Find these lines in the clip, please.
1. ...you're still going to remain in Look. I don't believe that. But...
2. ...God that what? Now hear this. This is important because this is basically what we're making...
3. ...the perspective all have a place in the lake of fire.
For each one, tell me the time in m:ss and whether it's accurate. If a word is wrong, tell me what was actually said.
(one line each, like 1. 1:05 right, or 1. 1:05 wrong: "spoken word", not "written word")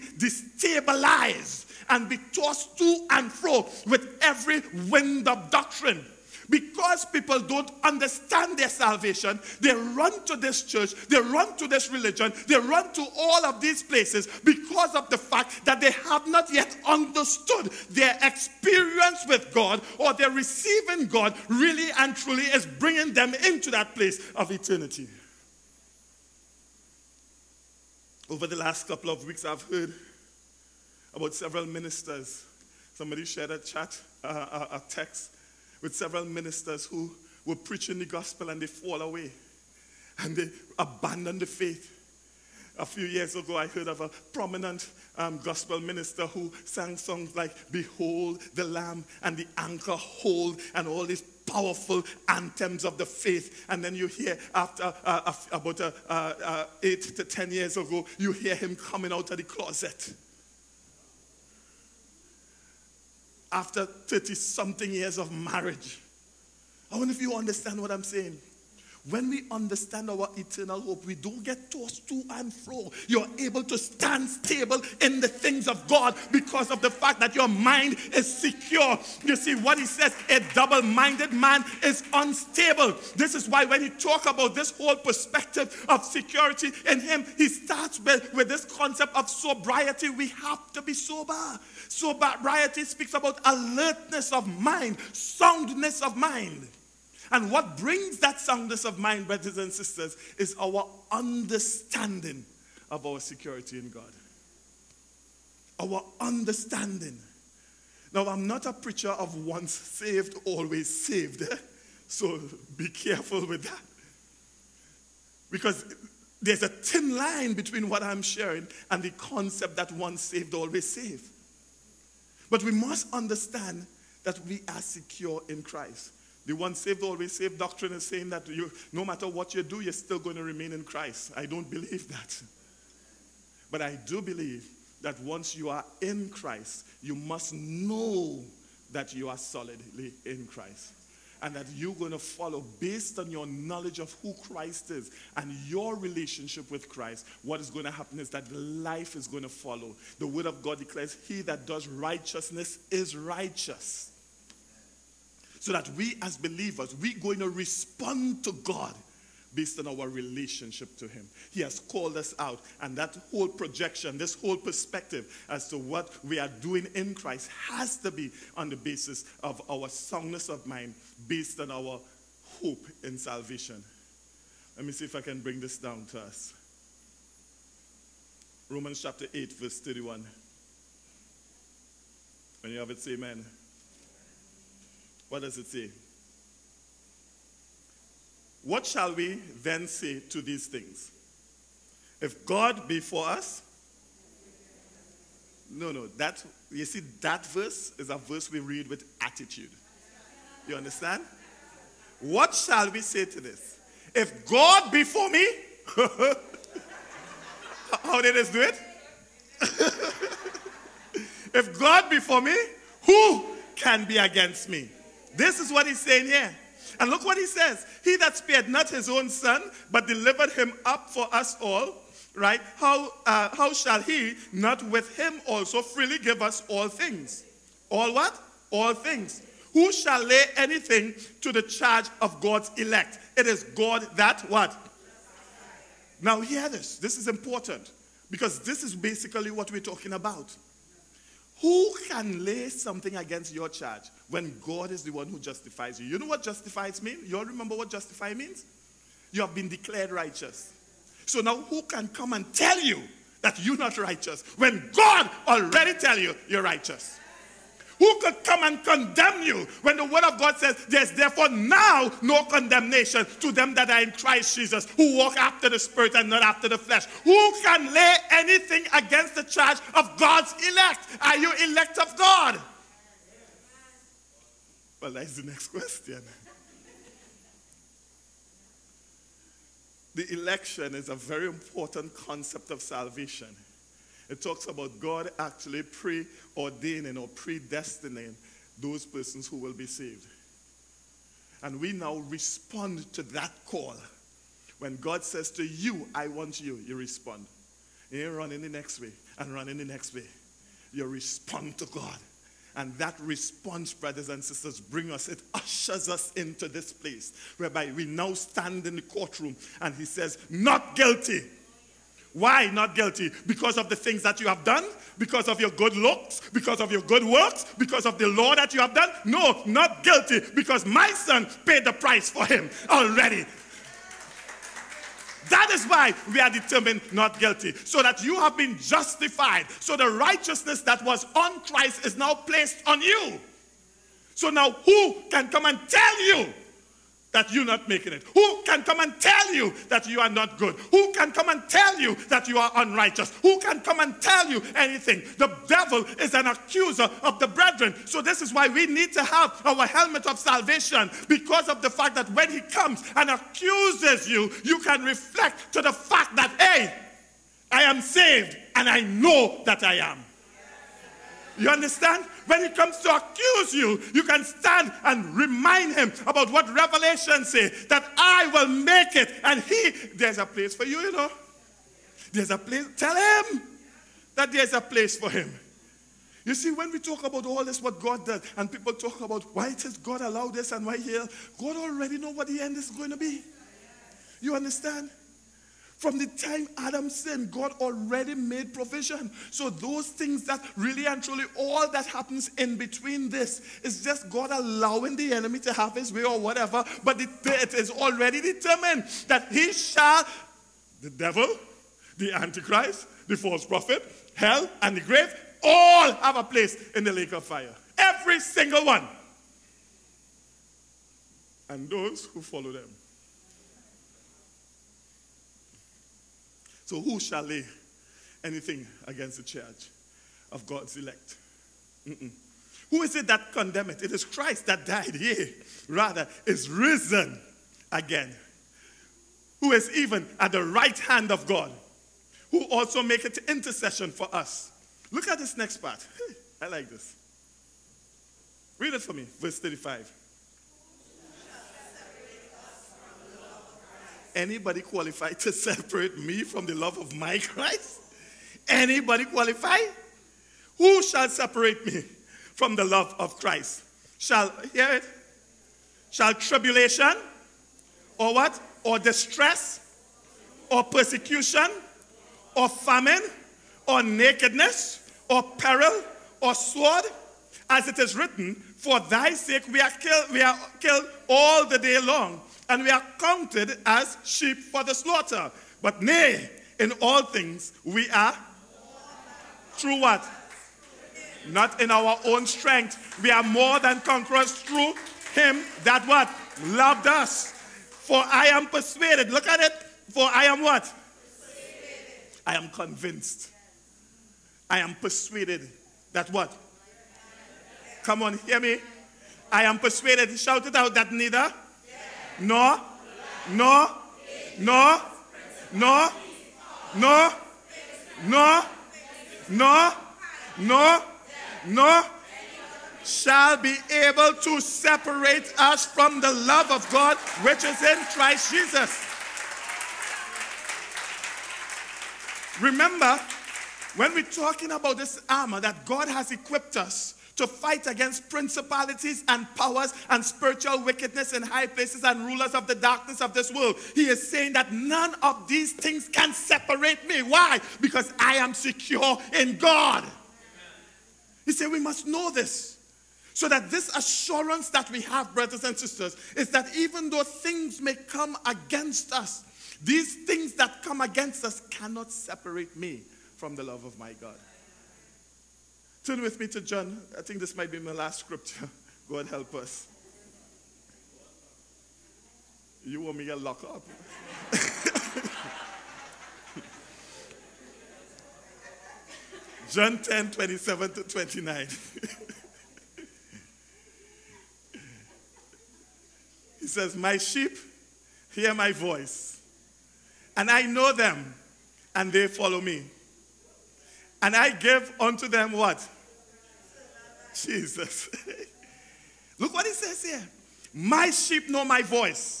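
1. 2:09 wrong: "Christ", not "Look"
2. 3:53 wrong: "talking", not "making"
3. 6:44 wrong: "grave", not "perspective".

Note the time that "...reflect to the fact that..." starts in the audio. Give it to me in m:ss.
5:55.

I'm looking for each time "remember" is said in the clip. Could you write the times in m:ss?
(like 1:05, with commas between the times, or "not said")
4:07, 8:42.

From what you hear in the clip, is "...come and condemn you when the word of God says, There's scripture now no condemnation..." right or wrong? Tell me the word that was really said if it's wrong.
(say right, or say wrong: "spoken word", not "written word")
wrong: "therefore", not "scripture".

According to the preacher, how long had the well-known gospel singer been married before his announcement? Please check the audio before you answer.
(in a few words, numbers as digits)
30 something years.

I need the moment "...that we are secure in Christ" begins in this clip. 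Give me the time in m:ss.
2:04.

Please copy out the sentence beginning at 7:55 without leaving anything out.
But nay, in all things we are through what?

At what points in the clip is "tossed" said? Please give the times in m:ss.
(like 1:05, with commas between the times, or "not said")
0:02, 1:11.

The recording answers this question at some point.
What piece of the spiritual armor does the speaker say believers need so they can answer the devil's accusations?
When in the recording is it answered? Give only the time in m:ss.
5:49.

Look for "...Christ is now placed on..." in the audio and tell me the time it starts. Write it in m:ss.
5:31.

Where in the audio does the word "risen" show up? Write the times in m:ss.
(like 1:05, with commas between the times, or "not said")
7:06.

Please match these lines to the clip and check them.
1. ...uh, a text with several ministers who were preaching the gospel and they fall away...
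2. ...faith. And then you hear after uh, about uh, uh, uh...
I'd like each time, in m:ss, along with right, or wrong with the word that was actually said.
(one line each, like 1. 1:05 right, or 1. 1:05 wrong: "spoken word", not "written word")
1. 0:34 right
2. 0:53 right.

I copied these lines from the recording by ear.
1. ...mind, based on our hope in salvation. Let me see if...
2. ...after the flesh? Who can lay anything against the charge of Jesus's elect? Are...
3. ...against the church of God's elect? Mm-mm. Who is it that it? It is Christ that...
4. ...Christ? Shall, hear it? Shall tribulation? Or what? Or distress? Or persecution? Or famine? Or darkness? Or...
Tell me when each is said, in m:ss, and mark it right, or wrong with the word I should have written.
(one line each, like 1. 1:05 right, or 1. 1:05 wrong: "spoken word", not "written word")
1. 2:50 right
2. 4:26 wrong: "God", not "Jesus"
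3. 6:59 right
4. 7:33 wrong: "nakedness", not "darkness".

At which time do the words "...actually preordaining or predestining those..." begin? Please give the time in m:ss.
4:45.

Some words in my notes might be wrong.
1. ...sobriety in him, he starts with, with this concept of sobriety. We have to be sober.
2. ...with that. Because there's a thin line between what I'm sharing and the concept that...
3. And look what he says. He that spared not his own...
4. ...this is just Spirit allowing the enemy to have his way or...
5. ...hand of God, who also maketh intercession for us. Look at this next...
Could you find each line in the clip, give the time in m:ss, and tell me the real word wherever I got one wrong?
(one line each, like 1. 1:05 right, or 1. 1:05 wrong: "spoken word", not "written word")
1. 1:26 wrong: "security", not "sobriety"
2. 1:53 right
3. 3:36 right
4. 6:33 wrong: "God", not "Spirit"
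5. 7:10 right.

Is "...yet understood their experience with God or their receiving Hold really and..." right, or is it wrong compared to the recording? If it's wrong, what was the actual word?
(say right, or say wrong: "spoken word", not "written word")
wrong: "God", not "Hold".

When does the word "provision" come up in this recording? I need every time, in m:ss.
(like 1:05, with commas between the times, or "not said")
6:28.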